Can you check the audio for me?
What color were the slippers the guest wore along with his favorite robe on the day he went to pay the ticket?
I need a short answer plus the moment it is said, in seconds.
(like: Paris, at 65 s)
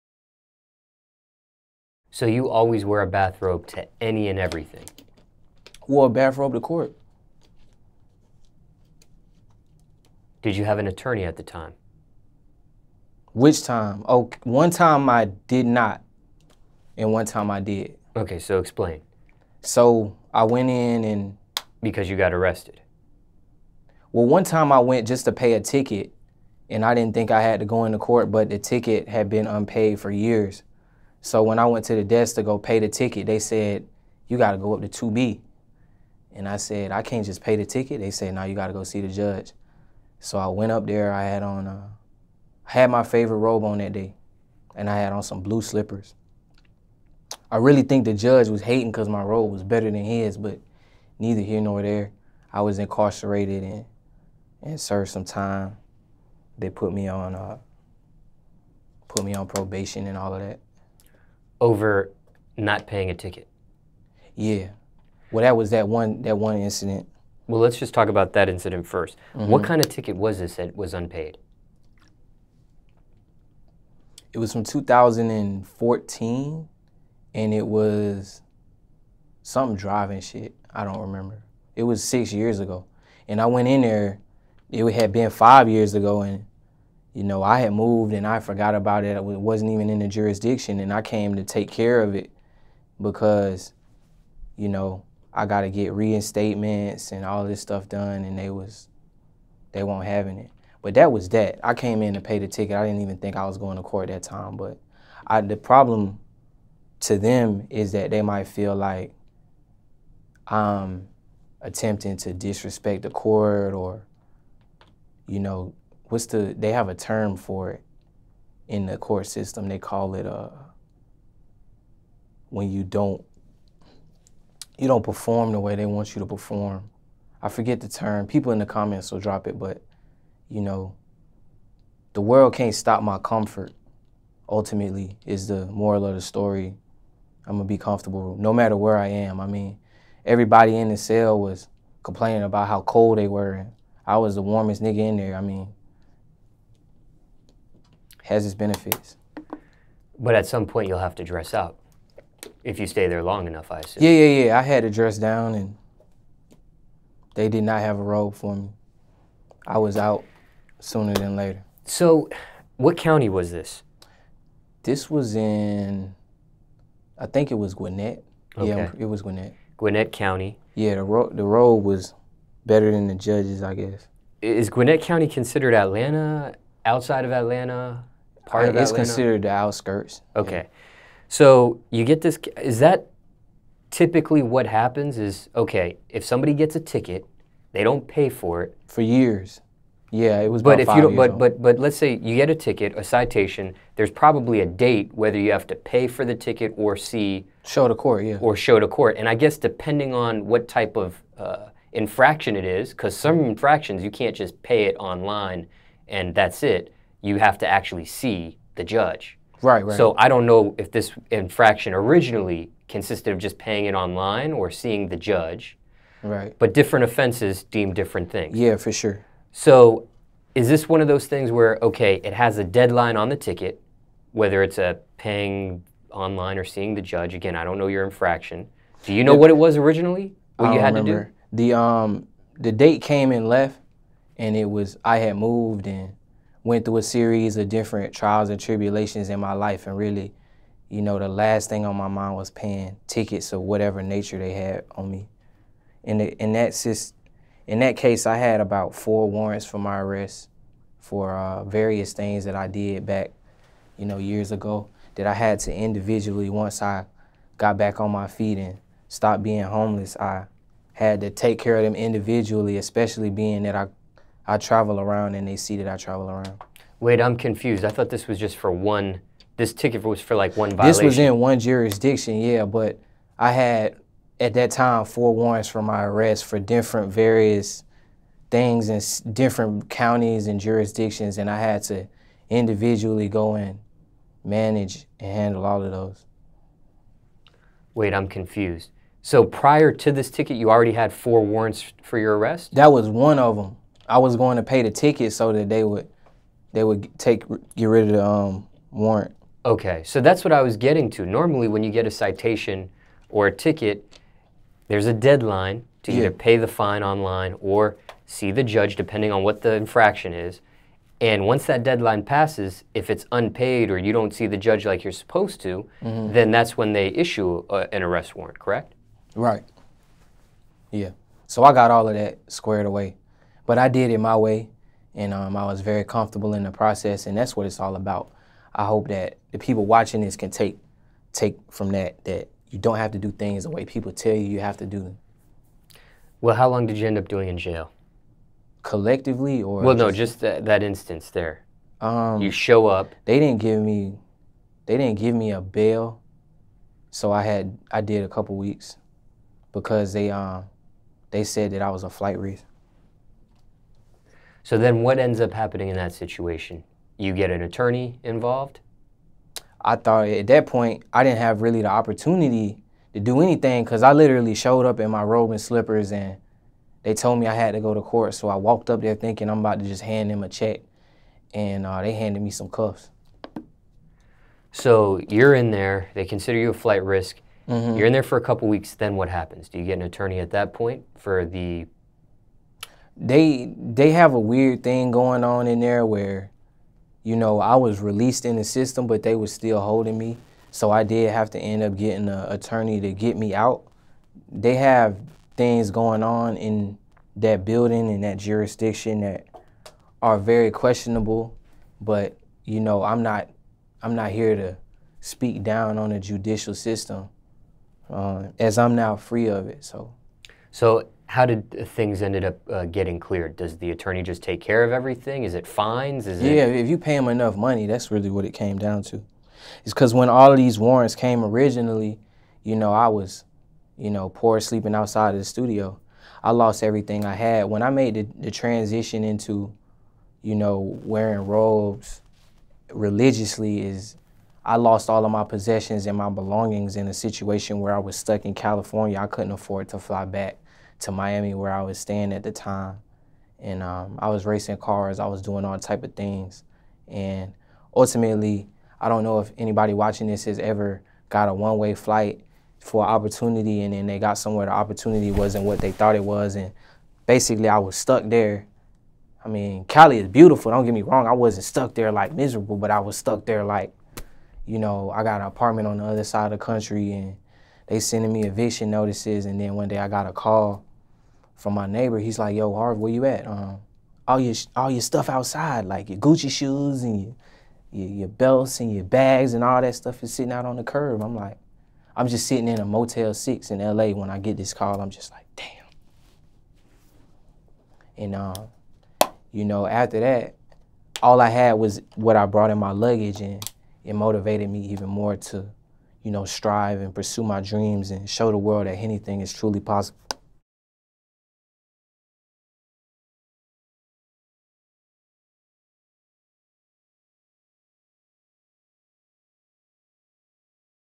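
Blue, at 45 s.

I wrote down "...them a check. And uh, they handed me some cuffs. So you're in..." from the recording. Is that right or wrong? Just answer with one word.
right.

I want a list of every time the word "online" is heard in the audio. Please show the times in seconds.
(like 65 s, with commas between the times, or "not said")
204 s, 213 s, 226 s, 307 s.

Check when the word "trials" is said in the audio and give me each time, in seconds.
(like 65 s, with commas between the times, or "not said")
238 s.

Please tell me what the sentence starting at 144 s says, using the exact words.
I was the warmest nigga in there.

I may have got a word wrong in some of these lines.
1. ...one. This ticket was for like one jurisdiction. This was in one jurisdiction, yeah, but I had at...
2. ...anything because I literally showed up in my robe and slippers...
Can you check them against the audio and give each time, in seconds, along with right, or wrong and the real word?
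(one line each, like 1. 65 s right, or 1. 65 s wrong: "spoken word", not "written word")
1. 268 s wrong: "violation", not "jurisdiction"
2. 363 s right.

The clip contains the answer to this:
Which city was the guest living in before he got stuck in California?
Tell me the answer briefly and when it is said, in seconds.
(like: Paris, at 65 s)
Miami, at 441 s.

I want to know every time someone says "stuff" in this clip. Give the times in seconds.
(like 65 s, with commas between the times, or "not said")
97 s, 475 s, 479 s.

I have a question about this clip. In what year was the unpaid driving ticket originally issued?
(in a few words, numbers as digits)
2014.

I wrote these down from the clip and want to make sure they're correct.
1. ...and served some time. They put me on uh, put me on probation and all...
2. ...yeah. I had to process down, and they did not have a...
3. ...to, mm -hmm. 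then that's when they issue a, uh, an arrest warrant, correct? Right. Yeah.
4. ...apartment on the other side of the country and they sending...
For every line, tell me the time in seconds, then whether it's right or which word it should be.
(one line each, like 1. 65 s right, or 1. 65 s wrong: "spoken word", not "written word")
1. 54 s right
2. 154 s wrong: "dress", not "process"
3. 315 s right
4. 465 s right.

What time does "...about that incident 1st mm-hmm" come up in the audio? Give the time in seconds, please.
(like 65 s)
68 s.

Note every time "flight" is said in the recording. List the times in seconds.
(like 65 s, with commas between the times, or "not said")
352 s, 376 s, 451 s.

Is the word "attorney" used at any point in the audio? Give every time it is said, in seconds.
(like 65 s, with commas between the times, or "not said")
10 s, 357 s, 380 s, 392 s, 413 s.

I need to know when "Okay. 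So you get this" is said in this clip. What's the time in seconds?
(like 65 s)
180 s.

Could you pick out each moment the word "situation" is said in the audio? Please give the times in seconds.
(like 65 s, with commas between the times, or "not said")
356 s, 437 s.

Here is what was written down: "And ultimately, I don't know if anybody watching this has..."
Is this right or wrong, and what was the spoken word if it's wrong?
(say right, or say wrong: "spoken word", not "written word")
right.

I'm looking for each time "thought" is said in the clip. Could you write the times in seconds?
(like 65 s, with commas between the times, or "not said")
267 s, 359 s, 455 s.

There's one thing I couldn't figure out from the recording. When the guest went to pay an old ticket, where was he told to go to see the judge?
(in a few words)
2B.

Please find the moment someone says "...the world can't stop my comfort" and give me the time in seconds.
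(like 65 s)
132 s.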